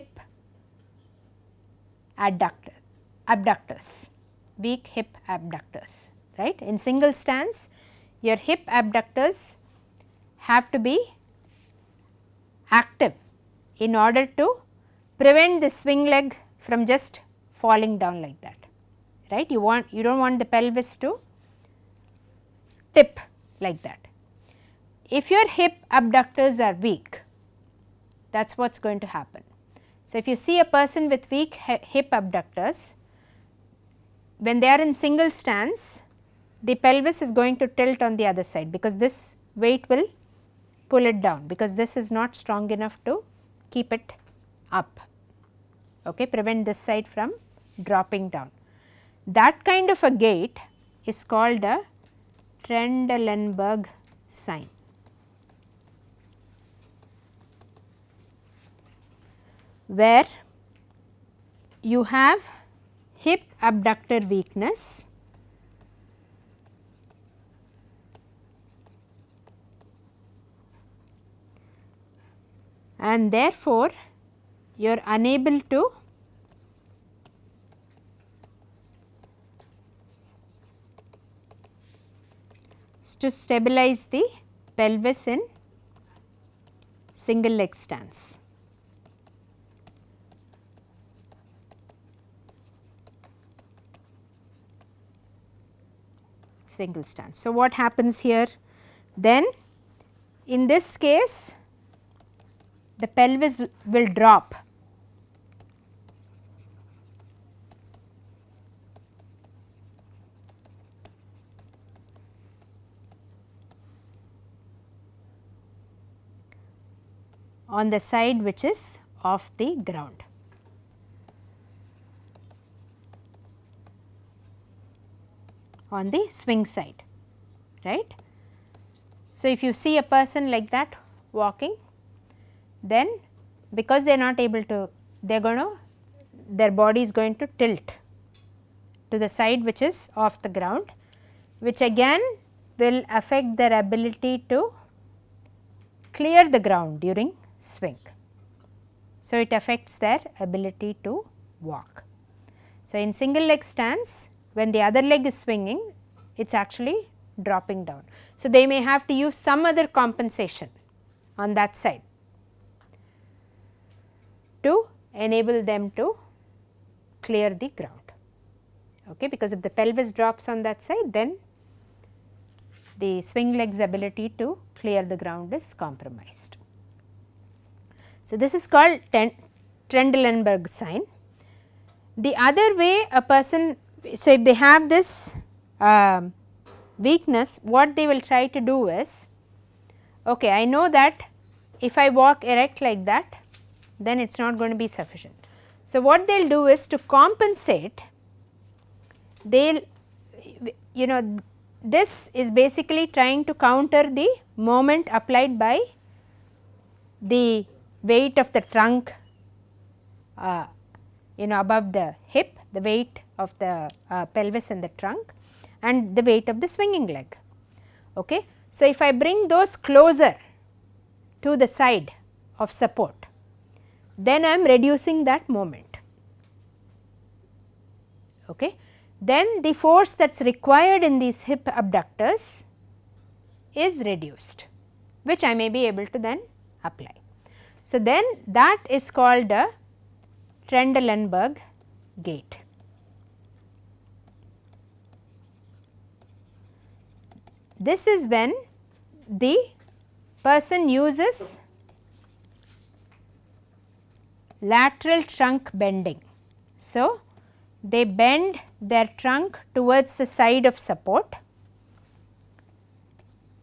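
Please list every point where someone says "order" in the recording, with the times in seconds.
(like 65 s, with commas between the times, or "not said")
13 s.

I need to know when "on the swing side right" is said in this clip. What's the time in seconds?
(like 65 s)
125 s.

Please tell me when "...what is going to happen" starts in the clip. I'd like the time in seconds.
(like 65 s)
28 s.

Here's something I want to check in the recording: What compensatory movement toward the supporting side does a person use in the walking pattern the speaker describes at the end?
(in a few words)
Lateral trunk bending.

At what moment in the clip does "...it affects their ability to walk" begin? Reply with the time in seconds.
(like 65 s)
149 s.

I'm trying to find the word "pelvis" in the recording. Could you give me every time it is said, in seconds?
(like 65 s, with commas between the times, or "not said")
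20 s, 36 s, 84 s, 103 s, 169 s, 214 s.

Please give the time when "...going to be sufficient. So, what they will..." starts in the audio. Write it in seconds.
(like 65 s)
194 s.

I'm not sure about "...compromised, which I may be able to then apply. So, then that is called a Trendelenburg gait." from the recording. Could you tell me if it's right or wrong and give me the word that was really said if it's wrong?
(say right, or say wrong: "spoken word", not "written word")
wrong: "reduced", not "compromised".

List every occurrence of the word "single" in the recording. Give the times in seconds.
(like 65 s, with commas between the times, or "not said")
6 s, 34 s, 87 s, 96 s, 153 s.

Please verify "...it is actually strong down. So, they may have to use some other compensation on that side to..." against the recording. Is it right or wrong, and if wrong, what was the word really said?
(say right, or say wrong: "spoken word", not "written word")
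wrong: "dropping", not "strong".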